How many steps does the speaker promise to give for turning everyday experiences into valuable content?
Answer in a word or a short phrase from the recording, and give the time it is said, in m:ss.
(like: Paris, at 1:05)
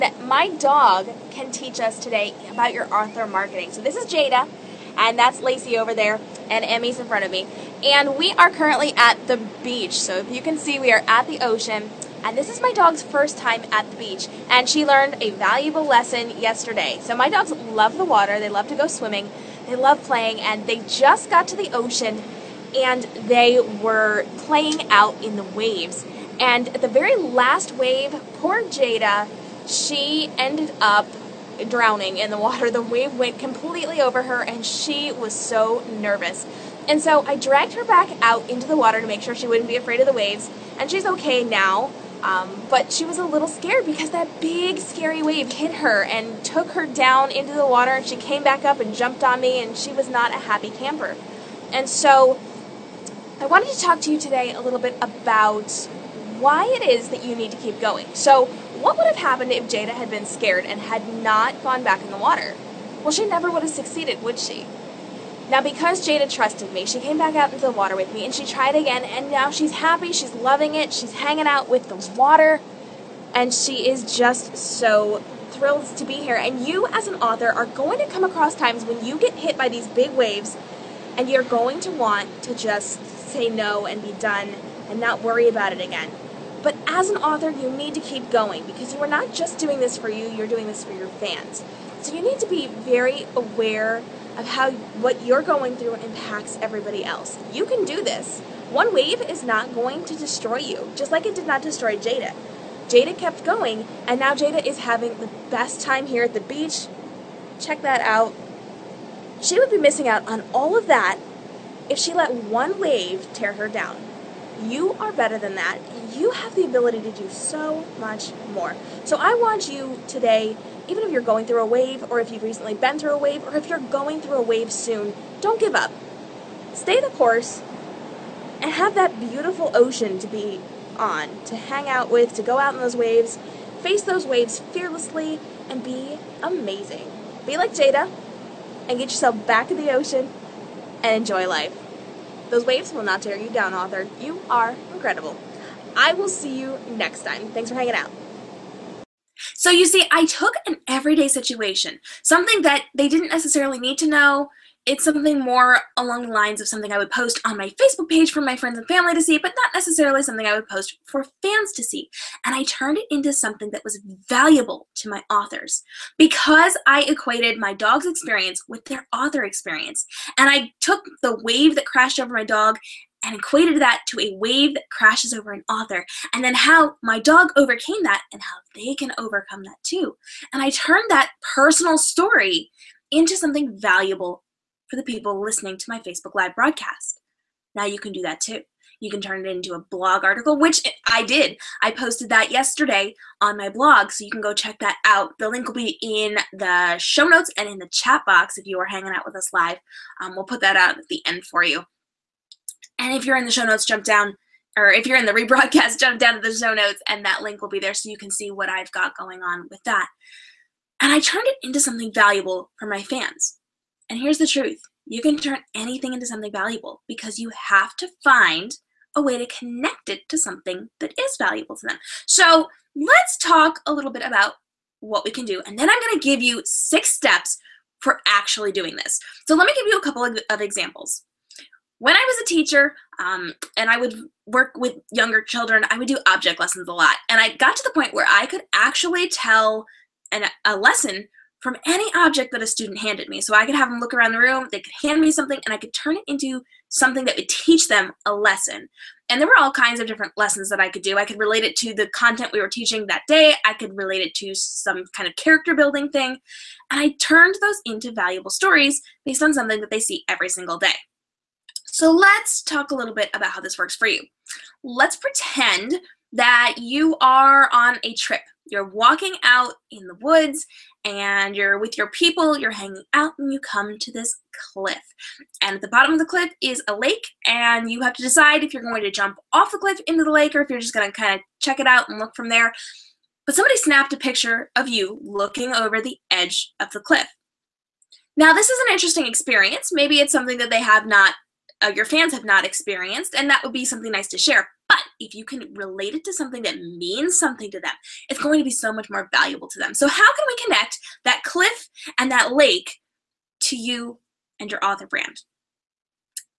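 6, at 3:46.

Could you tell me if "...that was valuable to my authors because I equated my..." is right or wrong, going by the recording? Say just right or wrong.
right.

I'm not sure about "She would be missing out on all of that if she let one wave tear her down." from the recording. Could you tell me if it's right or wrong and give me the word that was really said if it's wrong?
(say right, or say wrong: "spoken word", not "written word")
right.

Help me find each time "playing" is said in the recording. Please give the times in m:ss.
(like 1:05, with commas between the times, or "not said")
0:20, 0:24.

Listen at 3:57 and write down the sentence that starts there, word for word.
And I got to the point where I could actually tell an, a lesson from any object that a student handed me.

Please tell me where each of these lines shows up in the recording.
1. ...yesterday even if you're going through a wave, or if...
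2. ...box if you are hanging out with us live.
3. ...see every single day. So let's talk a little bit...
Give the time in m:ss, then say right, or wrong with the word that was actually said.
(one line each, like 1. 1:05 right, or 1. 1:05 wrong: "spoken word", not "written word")
1. 2:00 wrong: "today", not "yesterday"
2. 3:18 right
3. 4:20 right.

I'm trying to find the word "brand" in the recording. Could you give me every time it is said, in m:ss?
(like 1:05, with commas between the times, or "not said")
5:05.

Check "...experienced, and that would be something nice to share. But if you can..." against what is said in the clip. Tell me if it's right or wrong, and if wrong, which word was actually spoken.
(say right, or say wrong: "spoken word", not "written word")
right.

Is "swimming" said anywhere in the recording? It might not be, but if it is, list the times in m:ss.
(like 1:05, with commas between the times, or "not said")
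0:18.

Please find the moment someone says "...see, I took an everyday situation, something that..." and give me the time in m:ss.
2:29.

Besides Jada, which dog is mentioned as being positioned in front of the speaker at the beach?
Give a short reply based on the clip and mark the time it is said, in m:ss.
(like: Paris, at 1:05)
Emmy, at 0:06.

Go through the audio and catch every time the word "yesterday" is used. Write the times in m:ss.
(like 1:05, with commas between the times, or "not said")
0:16, 3:12.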